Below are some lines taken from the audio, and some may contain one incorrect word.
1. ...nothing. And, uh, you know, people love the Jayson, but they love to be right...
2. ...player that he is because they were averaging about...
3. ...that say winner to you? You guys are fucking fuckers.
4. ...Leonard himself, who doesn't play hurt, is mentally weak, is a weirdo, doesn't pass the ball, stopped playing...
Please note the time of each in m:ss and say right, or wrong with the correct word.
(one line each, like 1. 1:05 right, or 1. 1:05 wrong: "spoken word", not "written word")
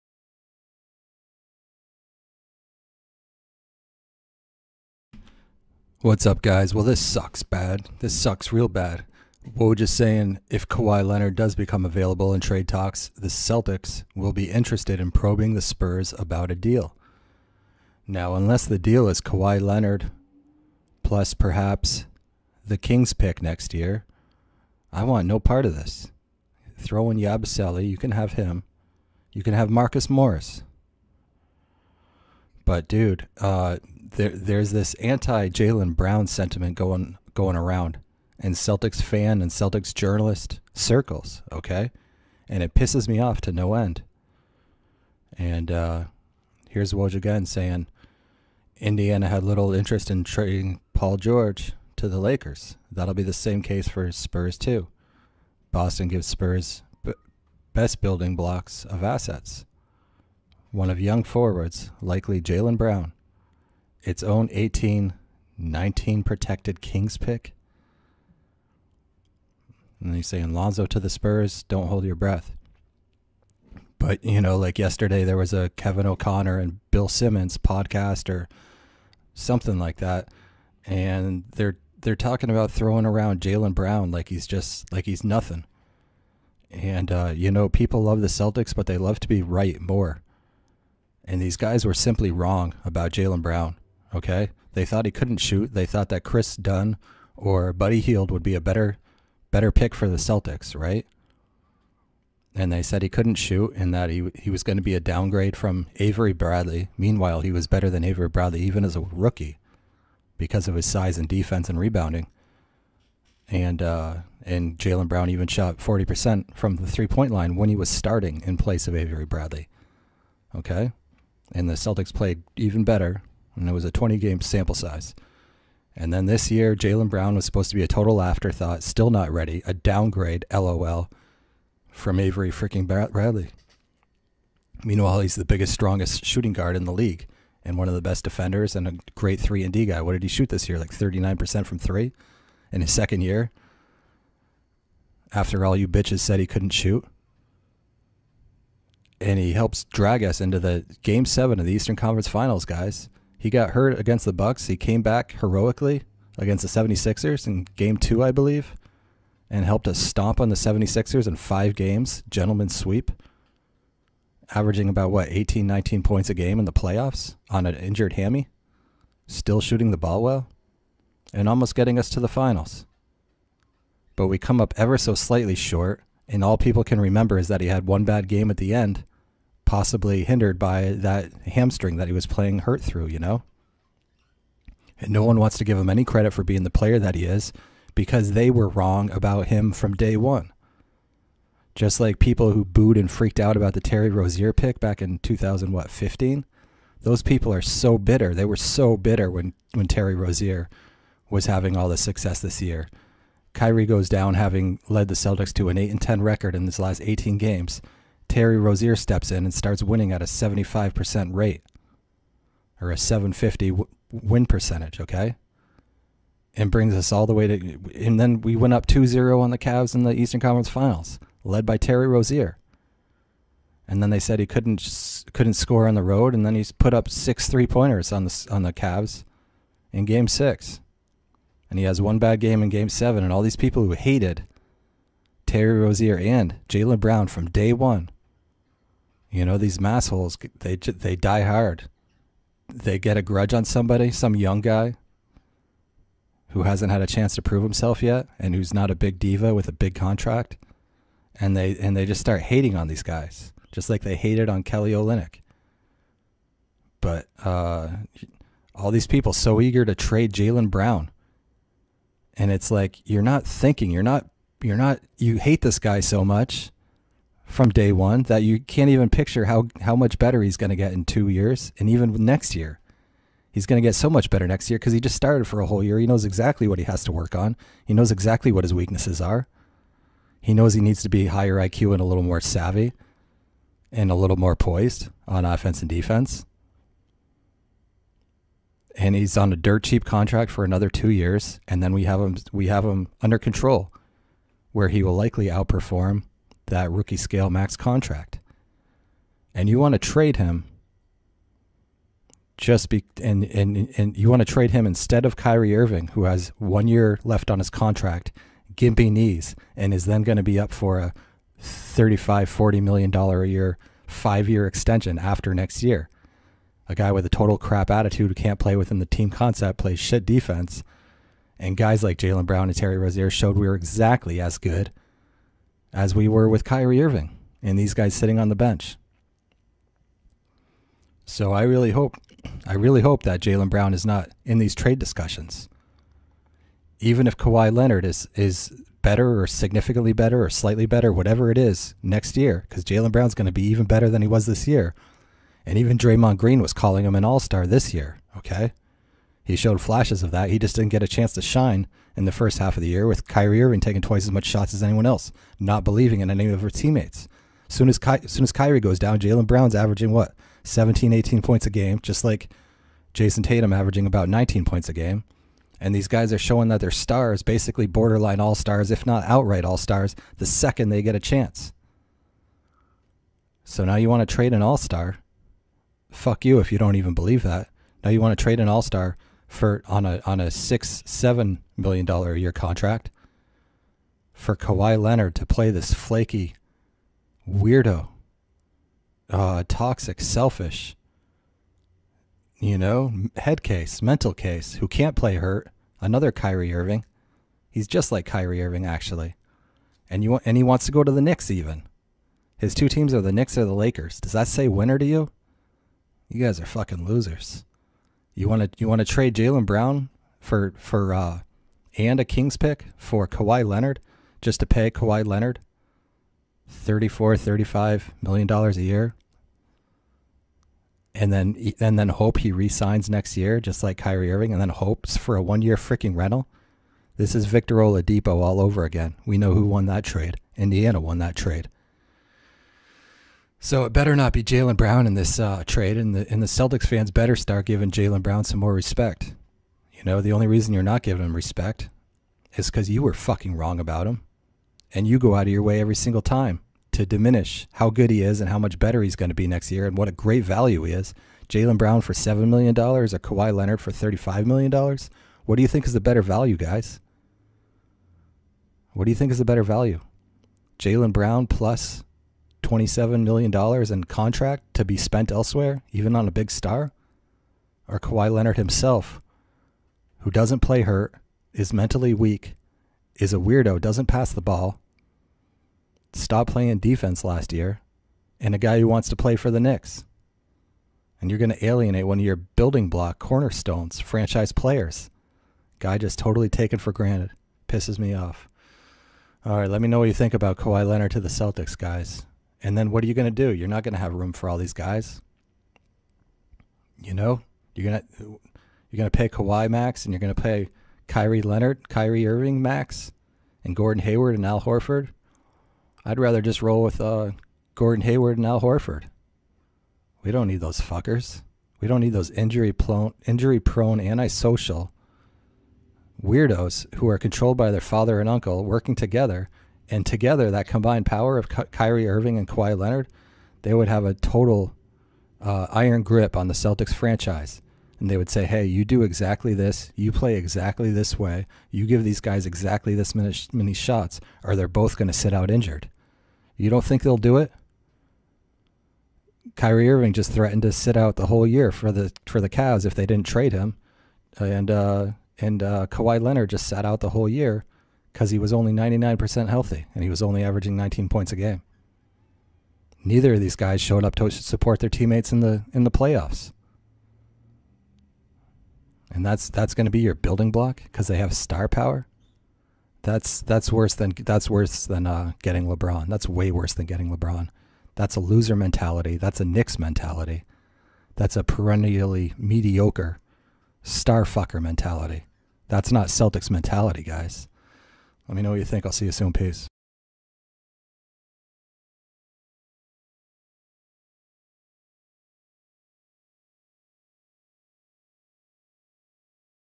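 1. 1:25 wrong: "Celtics", not "Jayson"
2. 3:06 wrong: "wrong", not "averaging"
3. 6:44 wrong: "losers", not "fuckers"
4. 7:48 right.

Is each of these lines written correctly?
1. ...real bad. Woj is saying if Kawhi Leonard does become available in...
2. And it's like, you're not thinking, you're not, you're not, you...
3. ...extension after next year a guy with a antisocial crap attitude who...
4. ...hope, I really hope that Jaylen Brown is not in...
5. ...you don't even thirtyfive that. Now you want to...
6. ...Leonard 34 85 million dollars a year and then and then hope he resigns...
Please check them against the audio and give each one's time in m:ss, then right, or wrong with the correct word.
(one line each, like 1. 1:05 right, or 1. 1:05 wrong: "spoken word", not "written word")
1. 0:08 right
2. 4:22 right
3. 5:14 wrong: "total", not "antisocial"
4. 5:31 right
5. 6:16 wrong: "believe", not "thirtyfive"
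6. 6:55 wrong: "35", not "85".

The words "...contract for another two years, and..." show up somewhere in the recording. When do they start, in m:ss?
4:50.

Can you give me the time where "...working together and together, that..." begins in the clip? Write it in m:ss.
8:38.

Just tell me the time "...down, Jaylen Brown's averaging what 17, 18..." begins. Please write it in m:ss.
5:58.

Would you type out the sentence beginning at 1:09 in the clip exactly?
And you say, Lonzo to the Spurs, don't hold your breath.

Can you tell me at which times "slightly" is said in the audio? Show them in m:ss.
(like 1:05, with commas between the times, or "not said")
2:55, 5:40.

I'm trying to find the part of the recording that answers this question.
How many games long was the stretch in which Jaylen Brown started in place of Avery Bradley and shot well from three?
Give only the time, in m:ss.
2:03.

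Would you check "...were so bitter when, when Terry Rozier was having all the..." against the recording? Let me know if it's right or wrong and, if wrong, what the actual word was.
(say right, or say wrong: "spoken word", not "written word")
right.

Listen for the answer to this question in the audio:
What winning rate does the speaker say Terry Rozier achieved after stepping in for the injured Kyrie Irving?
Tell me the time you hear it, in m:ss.
3:30.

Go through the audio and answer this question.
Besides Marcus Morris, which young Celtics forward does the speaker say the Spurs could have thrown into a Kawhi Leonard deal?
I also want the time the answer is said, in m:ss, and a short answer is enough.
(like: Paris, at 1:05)
Yabusele, at 0:27.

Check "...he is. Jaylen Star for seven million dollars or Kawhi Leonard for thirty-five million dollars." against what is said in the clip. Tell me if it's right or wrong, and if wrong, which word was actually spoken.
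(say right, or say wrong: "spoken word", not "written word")
wrong: "Brown", not "Star".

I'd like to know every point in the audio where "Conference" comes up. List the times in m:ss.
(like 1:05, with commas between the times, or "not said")
2:31, 3:40.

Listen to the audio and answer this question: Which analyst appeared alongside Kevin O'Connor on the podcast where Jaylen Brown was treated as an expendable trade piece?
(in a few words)
Bill Simmons.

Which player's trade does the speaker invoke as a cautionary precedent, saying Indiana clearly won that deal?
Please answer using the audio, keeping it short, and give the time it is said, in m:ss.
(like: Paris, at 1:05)
Victor Oladipo, at 7:07.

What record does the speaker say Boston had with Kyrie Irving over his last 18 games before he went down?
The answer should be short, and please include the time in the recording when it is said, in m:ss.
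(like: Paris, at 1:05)
8-10, at 3:25.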